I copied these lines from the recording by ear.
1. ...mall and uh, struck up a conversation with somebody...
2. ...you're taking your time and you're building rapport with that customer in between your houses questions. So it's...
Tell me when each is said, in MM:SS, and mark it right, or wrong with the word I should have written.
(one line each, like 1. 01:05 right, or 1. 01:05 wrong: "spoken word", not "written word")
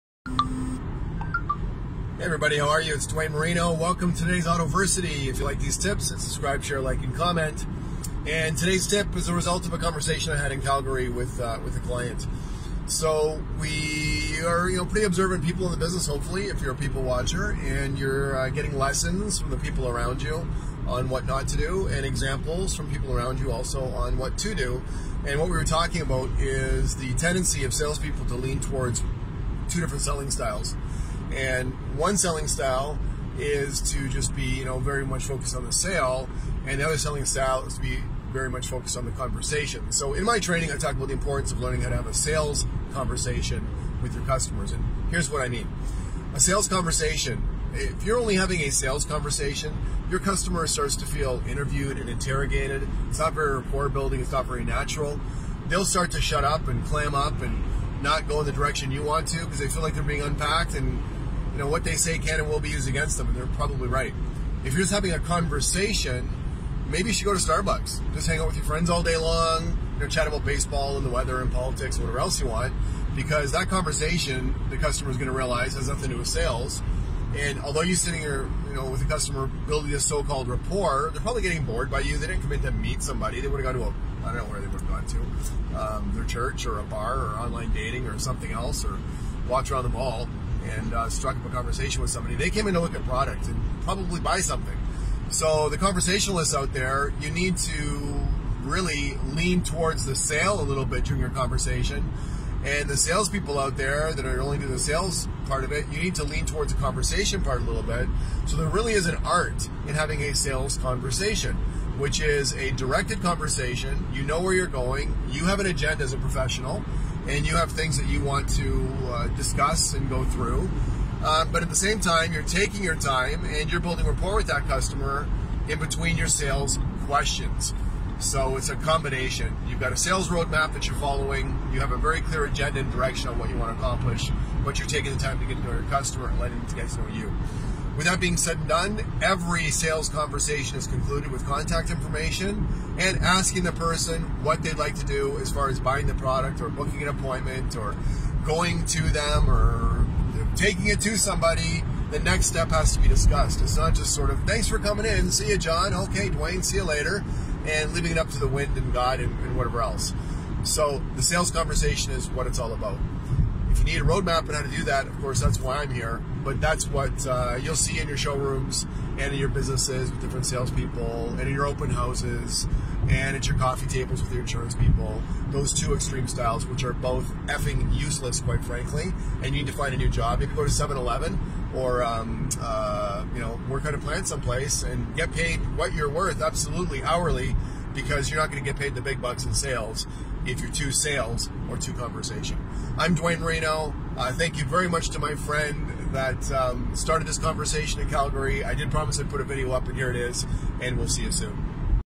1. 01:29 right
2. 02:02 wrong: "sales", not "houses".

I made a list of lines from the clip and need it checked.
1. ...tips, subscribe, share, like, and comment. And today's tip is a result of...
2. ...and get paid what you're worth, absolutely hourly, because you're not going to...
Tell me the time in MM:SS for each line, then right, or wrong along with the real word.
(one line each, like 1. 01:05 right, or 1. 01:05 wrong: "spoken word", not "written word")
1. 00:05 right
2. 03:04 right.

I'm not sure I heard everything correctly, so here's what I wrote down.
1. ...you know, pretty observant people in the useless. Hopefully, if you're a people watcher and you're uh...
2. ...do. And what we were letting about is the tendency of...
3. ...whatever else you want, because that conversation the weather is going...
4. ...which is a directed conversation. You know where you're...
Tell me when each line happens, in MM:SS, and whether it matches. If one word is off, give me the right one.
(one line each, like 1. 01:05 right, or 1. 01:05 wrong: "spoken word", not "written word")
1. 00:14 wrong: "business", not "useless"
2. 00:24 wrong: "talking", not "letting"
3. 01:12 wrong: "customer", not "weather"
4. 01:51 right.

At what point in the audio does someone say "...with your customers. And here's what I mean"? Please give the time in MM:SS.
00:44.